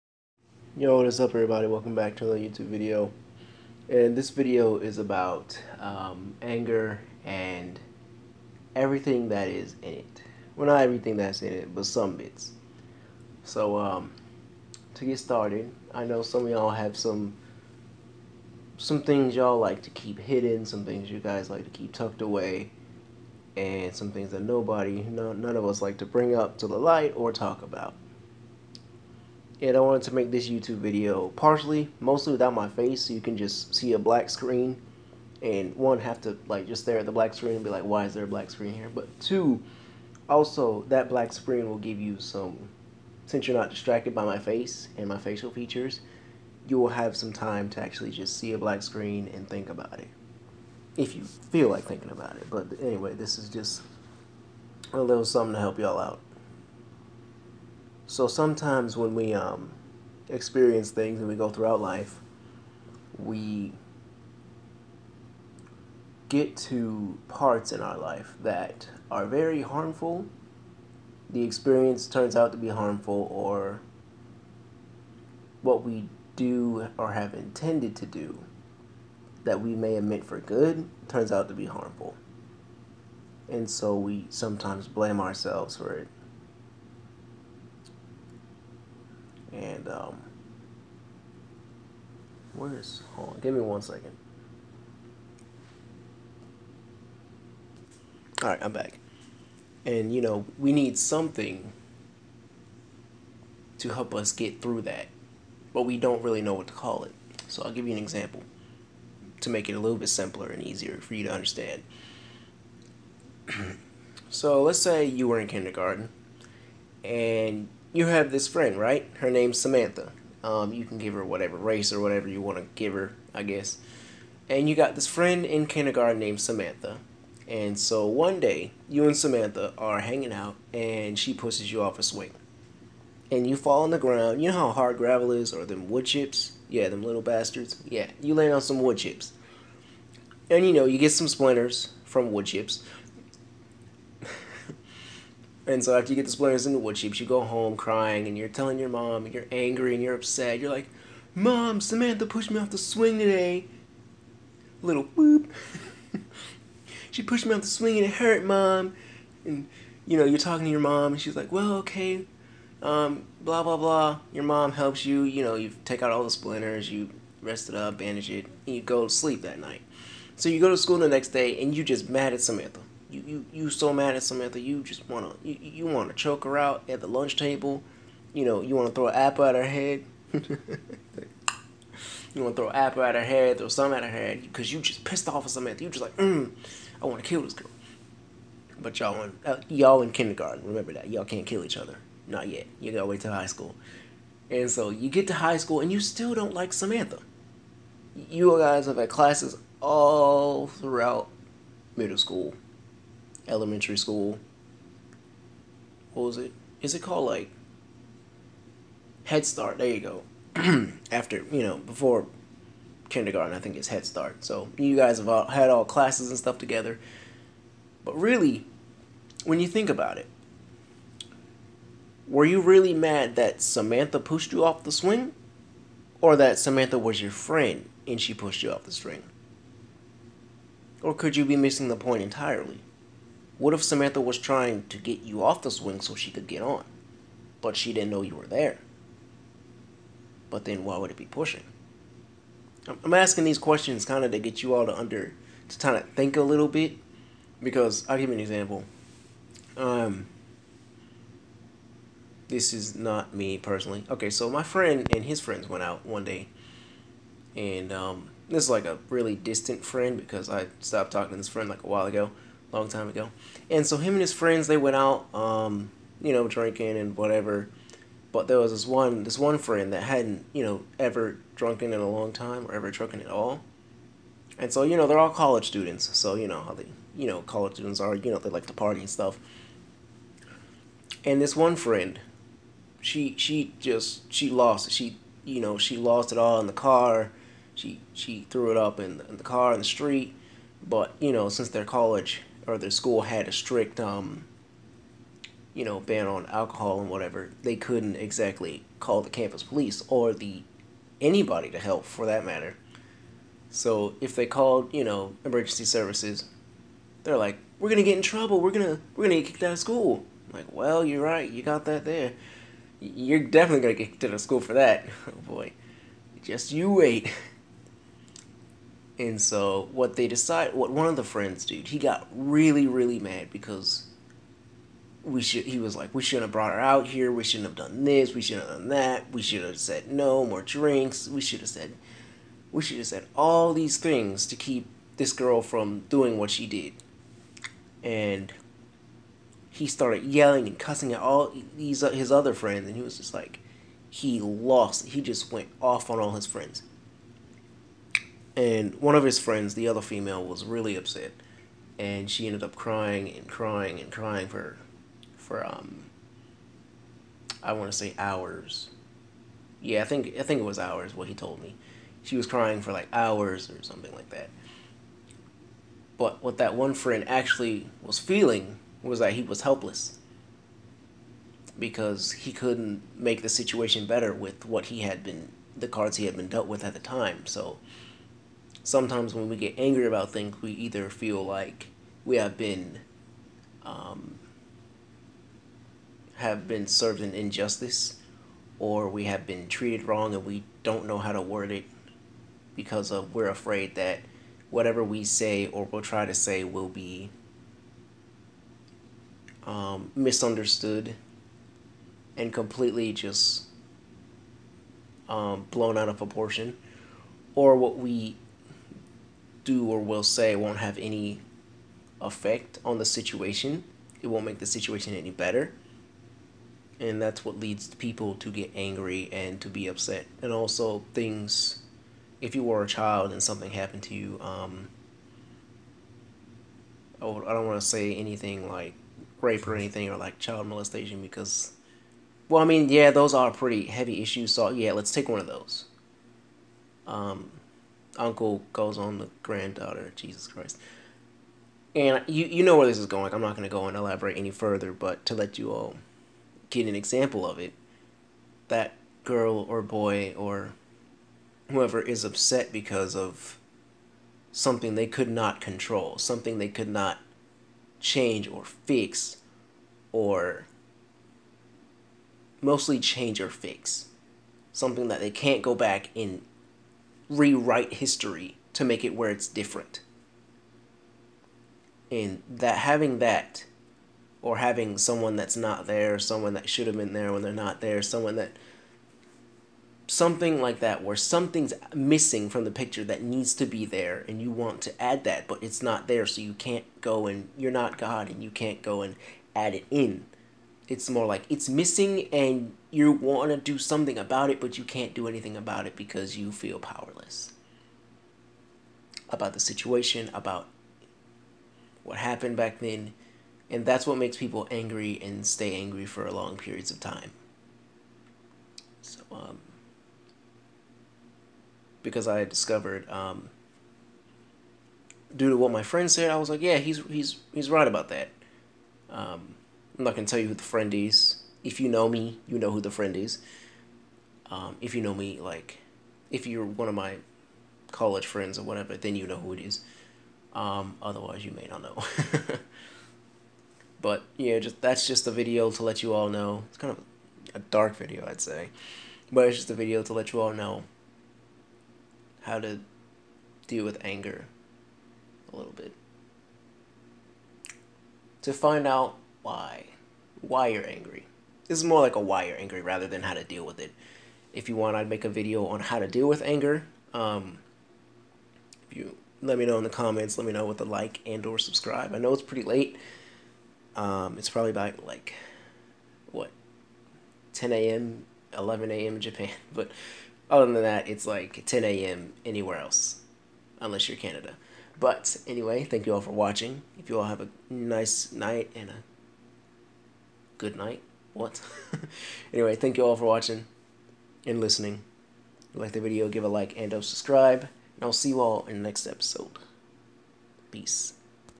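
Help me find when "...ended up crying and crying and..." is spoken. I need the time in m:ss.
5:52.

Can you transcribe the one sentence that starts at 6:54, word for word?
It won't make the situation any better.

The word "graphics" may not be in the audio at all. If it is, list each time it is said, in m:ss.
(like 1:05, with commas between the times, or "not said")
not said.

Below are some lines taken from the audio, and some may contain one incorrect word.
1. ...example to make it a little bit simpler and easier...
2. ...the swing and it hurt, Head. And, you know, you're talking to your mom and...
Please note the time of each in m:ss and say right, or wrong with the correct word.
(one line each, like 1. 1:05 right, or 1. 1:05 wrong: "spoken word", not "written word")
1. 1:48 right
2. 2:37 wrong: "Mom", not "Head".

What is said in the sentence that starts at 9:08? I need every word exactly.
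To find out why why you're angry.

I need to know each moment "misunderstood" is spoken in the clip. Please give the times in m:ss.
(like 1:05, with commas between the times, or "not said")
6:40.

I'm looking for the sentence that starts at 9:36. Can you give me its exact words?
If you all have a nice night and a good night.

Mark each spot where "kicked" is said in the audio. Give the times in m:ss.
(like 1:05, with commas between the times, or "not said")
5:09, 5:14.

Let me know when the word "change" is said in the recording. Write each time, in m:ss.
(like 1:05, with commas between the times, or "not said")
7:37, 7:42.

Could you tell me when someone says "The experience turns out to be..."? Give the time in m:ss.
1:11.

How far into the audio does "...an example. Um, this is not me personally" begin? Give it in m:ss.
4:08.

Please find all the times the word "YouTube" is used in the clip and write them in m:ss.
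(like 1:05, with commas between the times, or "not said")
0:02, 0:30.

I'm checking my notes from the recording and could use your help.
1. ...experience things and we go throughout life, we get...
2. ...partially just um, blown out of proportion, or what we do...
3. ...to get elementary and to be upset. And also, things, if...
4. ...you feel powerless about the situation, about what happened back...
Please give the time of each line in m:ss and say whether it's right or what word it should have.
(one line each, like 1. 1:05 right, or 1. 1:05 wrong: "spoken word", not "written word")
1. 1:00 right
2. 6:42 wrong: "completely", not "partially"
3. 6:58 wrong: "angry", not "elementary"
4. 8:16 right.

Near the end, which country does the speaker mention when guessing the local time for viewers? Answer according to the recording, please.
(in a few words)
Japan.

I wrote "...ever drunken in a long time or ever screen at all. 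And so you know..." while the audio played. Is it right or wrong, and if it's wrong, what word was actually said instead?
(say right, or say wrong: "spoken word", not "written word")
wrong: "drunken", not "screen".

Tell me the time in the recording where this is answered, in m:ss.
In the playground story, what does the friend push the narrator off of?
2:11.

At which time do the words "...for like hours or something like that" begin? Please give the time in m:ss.
6:02.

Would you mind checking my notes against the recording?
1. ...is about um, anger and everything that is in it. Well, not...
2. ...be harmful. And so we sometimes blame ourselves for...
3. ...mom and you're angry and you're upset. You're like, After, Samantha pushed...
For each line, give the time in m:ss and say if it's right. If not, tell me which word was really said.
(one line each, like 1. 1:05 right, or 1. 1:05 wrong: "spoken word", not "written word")
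1. 0:04 right
2. 1:21 right
3. 2:28 wrong: "Mom", not "After".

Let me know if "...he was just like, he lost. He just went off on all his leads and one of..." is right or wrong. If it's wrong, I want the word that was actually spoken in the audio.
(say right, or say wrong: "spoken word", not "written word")
wrong: "friends", not "leads".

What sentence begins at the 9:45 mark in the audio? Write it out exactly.
If you like the video, give a like and or subscribe.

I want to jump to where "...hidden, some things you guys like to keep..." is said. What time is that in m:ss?
0:20.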